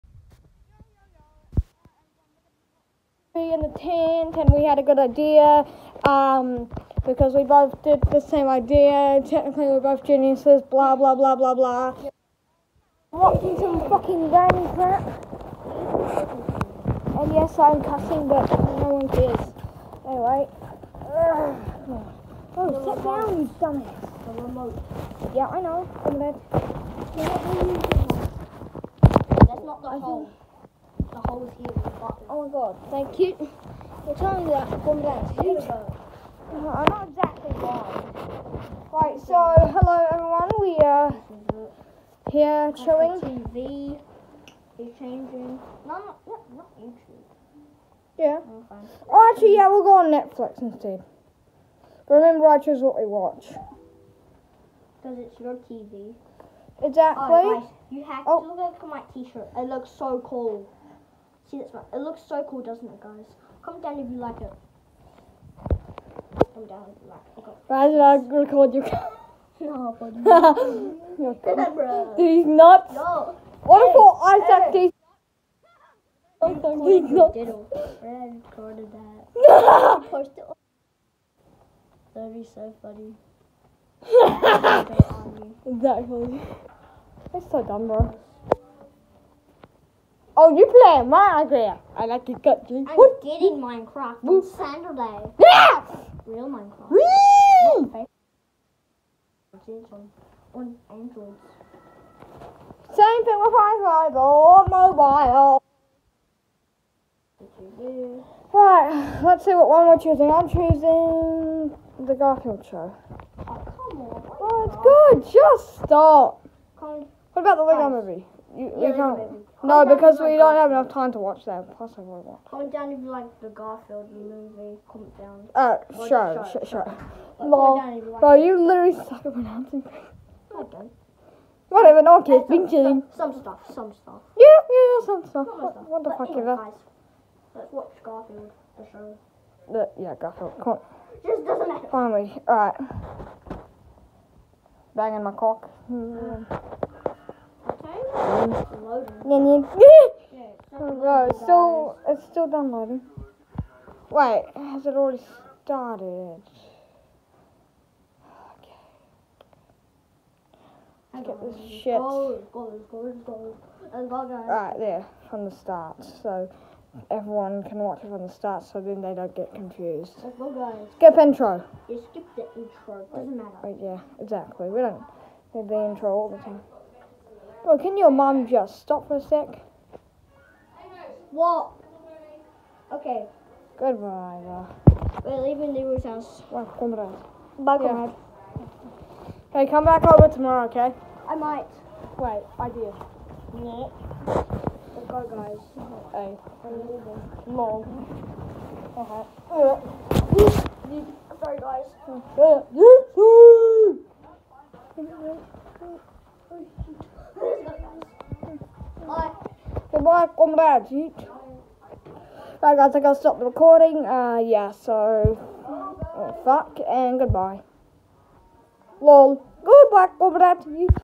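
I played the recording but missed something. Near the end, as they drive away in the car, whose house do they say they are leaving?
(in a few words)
Leroy's.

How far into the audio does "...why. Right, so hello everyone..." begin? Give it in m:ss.
0:37.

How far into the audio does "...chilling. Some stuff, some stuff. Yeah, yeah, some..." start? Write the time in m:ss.
2:12.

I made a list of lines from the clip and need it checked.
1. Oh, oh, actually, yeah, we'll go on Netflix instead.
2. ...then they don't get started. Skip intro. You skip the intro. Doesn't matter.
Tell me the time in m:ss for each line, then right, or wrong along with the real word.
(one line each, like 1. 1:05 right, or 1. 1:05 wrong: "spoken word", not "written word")
1. 0:48 right
2. 2:48 wrong: "confused", not "started".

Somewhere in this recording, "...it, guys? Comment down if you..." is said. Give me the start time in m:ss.
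1:02.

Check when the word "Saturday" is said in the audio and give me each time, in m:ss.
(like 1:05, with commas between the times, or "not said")
1:34.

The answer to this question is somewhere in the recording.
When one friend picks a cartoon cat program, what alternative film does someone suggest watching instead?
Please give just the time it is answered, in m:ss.
1:57.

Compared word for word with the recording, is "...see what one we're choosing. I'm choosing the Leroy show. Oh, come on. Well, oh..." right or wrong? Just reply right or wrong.
wrong.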